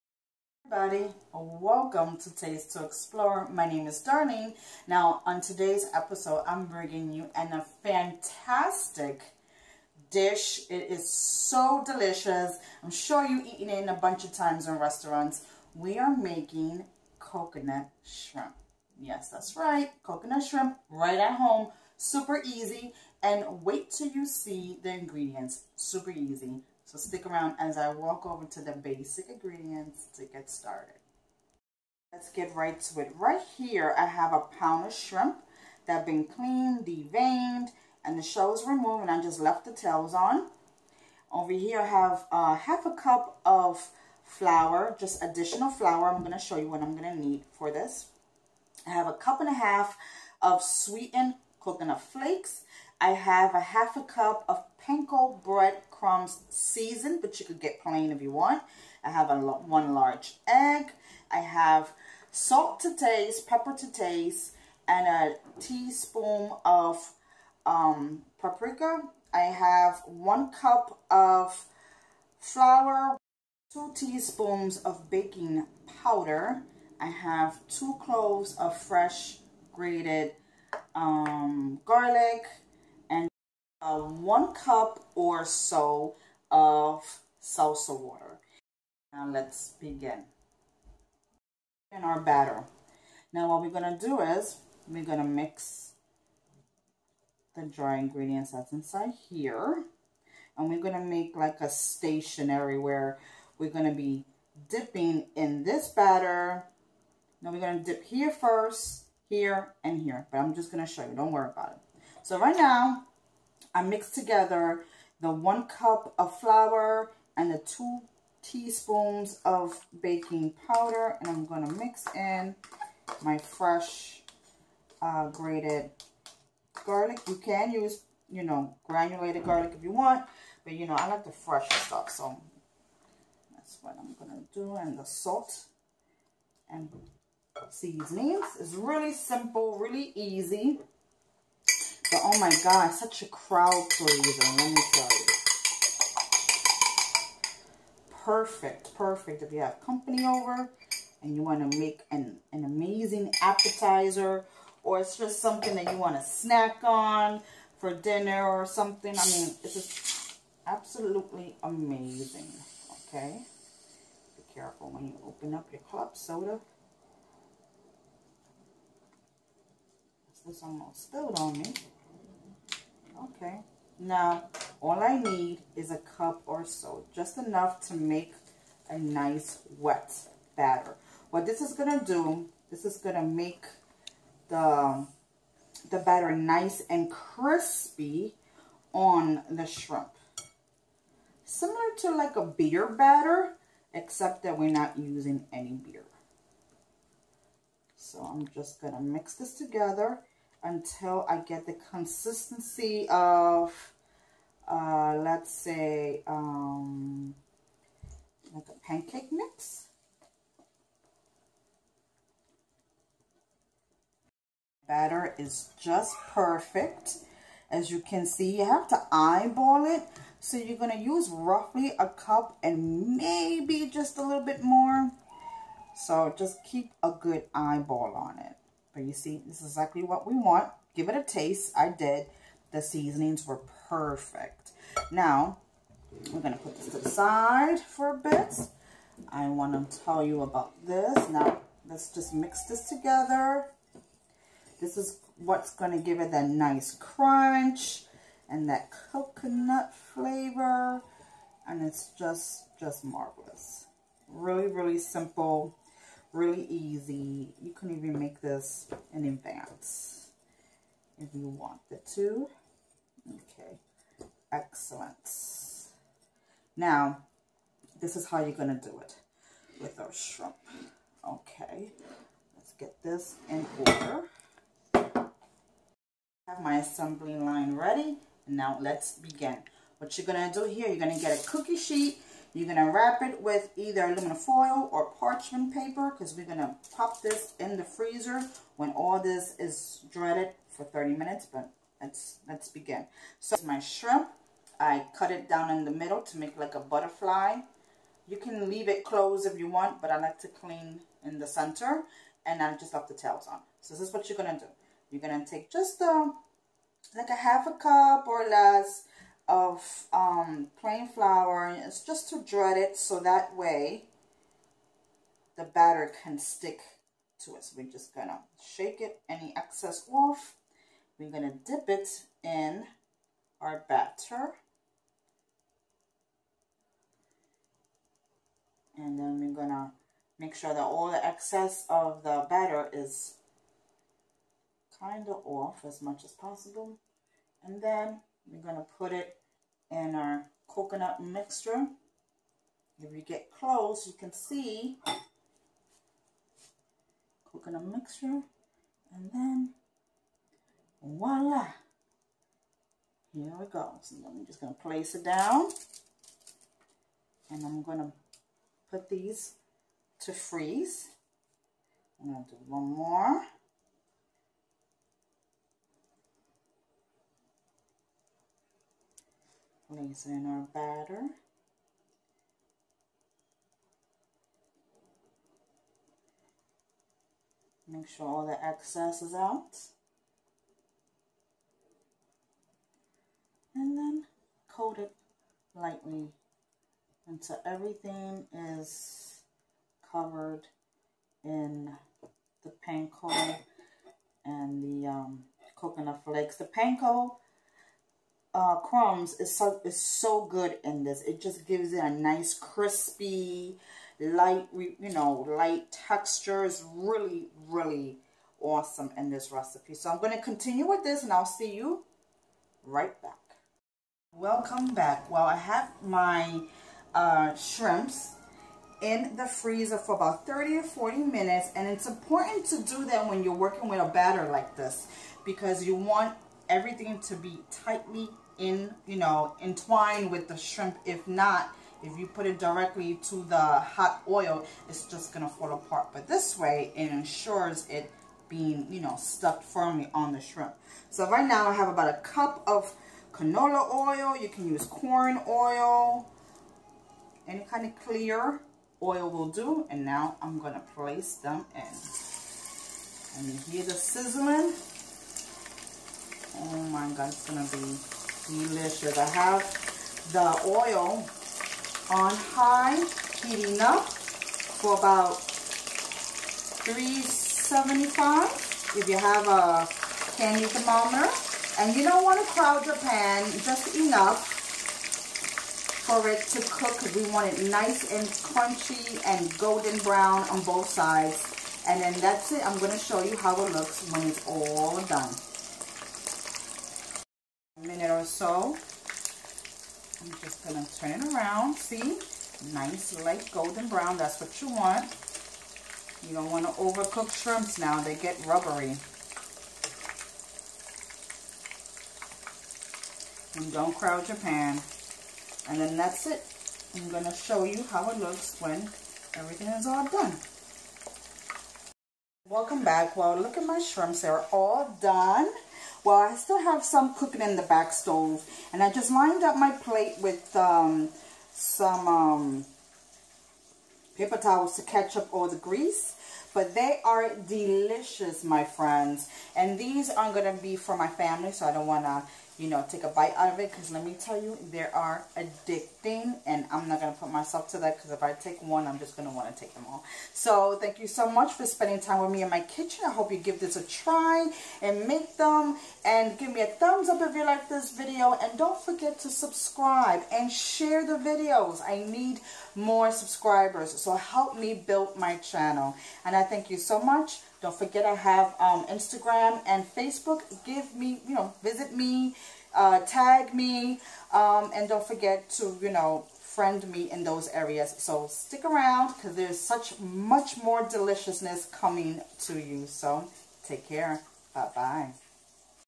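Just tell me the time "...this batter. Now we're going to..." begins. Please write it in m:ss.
1:45.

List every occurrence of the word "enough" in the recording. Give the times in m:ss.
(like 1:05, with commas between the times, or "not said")
2:57, 7:53.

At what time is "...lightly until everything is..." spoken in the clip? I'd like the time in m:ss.
6:25.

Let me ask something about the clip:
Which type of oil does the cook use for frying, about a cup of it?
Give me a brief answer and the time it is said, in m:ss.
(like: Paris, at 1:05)
canola oil, at 7:23.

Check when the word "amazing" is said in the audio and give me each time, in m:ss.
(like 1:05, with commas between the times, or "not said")
2:32, 2:41.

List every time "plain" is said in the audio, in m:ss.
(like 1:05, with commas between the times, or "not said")
0:57, 5:10.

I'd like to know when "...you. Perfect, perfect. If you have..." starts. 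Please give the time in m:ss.
2:25.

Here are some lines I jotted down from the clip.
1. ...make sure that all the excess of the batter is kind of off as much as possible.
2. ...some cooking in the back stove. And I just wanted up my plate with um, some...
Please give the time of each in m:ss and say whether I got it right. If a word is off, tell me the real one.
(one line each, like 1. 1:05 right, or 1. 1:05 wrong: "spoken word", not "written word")
1. 5:30 right
2. 8:36 wrong: "lined", not "wanted".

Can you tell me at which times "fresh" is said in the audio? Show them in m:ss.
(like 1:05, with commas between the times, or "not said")
1:18, 2:03, 2:11.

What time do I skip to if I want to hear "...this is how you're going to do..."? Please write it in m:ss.
4:27.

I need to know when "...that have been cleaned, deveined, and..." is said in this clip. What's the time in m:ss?
0:35.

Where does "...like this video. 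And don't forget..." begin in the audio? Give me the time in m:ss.
9:07.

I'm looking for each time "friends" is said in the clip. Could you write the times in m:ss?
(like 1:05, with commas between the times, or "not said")
8:48, 9:26.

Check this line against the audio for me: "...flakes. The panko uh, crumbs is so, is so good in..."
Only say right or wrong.
right.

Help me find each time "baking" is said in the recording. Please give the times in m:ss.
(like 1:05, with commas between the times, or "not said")
1:15, 2:00.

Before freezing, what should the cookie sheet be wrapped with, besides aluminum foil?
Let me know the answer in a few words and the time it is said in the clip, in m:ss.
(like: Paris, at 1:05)
parchment paper, at 4:45.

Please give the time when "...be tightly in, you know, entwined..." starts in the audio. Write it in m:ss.
7:07.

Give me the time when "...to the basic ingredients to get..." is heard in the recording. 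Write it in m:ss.
0:28.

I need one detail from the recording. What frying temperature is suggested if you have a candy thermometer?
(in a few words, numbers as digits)
375.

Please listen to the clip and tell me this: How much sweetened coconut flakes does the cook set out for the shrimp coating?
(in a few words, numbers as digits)
1.5 cups.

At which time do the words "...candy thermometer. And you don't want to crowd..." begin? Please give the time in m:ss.
7:50.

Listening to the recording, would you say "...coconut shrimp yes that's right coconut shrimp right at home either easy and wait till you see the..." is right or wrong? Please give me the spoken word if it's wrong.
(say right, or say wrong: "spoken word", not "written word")
wrong: "super", not "either".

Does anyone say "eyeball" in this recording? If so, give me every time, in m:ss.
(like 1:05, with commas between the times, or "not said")
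3:39, 3:47.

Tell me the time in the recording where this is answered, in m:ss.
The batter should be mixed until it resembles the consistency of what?
3:28.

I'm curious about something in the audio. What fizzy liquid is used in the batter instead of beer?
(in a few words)
seltzer water.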